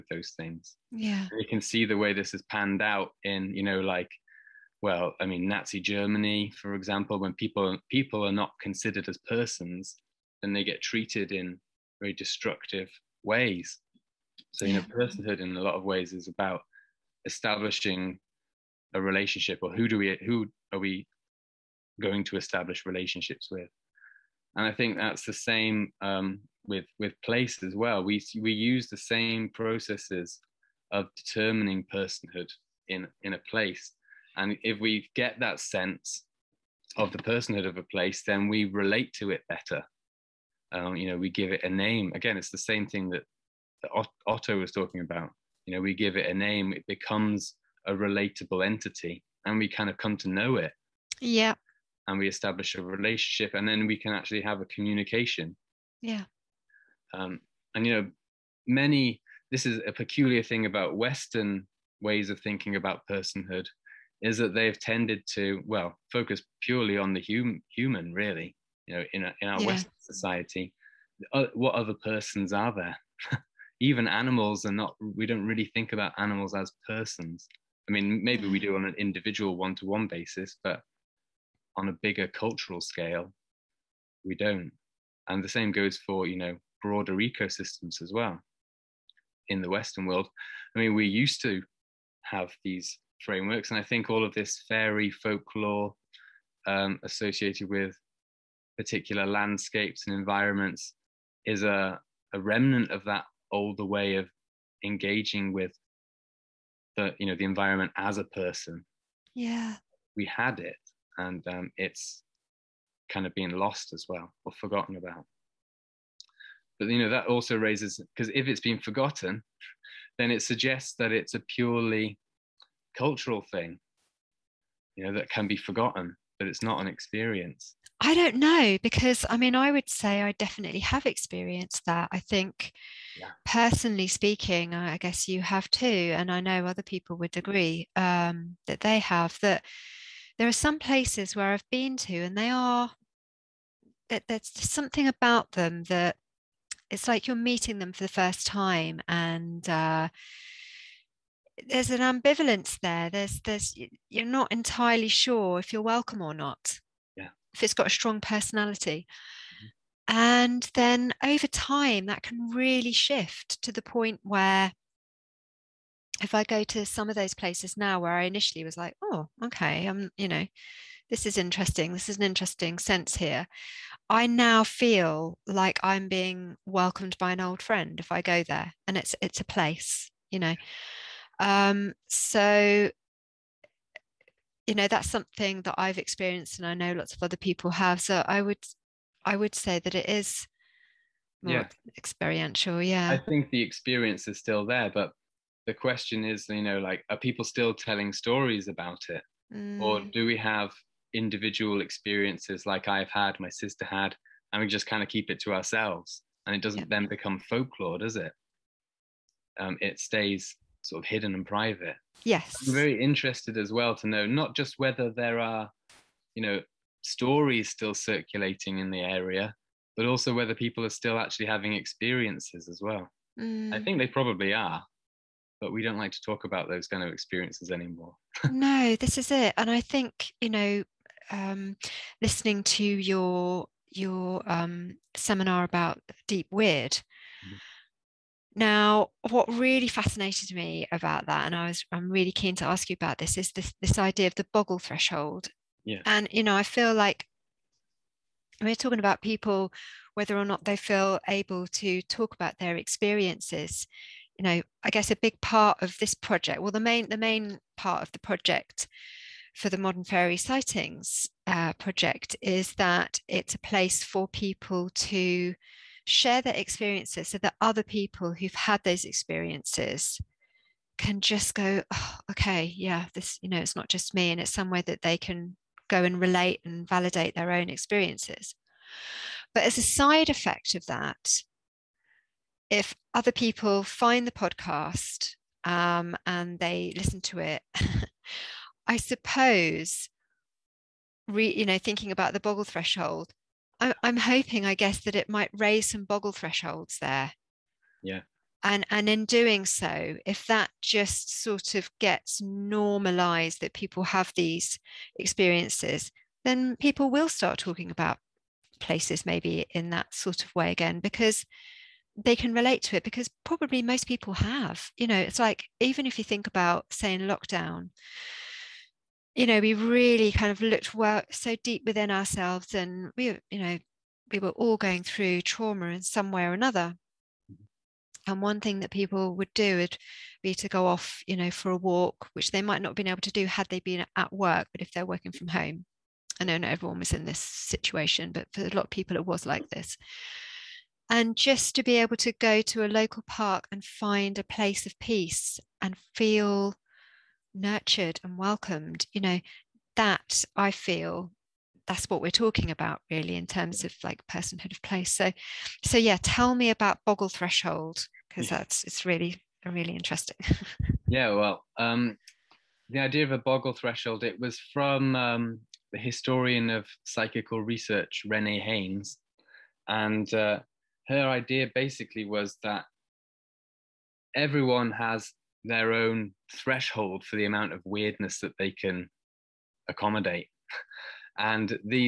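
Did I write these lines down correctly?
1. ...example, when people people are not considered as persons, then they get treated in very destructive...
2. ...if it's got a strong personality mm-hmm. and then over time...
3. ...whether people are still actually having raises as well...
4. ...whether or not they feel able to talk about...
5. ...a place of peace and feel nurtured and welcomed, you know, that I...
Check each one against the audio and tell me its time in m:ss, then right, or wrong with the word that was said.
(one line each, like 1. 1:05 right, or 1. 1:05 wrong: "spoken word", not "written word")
1. 0:06 right
2. 2:37 right
3. 3:40 wrong: "experiences", not "raises"
4. 4:10 right
5. 5:44 right.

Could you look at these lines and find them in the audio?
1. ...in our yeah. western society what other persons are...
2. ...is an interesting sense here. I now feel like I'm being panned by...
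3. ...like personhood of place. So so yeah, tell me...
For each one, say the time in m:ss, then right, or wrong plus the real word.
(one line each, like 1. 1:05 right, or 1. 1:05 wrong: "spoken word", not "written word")
1. 1:09 right
2. 2:52 wrong: "welcomed", not "panned"
3. 5:54 right.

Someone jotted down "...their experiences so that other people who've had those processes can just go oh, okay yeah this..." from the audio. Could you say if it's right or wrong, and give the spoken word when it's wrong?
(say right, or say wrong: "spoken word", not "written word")
wrong: "experiences", not "processes".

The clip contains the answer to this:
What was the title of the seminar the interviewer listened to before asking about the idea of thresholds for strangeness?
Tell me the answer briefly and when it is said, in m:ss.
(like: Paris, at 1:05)
Deep Weird, at 3:56.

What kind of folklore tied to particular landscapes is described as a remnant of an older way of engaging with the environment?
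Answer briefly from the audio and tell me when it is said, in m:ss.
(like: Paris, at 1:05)
fairy folklore, at 1:34.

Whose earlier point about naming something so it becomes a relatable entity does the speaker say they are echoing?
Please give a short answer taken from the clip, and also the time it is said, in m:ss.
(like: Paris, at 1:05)
Otto, at 0:44.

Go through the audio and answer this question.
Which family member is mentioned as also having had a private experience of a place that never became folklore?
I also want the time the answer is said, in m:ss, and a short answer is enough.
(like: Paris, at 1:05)
sister, at 3:23.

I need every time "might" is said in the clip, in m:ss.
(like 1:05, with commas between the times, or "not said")
4:55, 5:32.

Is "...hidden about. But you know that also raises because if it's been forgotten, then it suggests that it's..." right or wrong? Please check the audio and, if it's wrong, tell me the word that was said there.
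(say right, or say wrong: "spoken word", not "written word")
wrong: "forgotten", not "hidden".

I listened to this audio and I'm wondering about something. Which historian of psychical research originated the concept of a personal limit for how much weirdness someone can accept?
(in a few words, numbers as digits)
Renee Haynes.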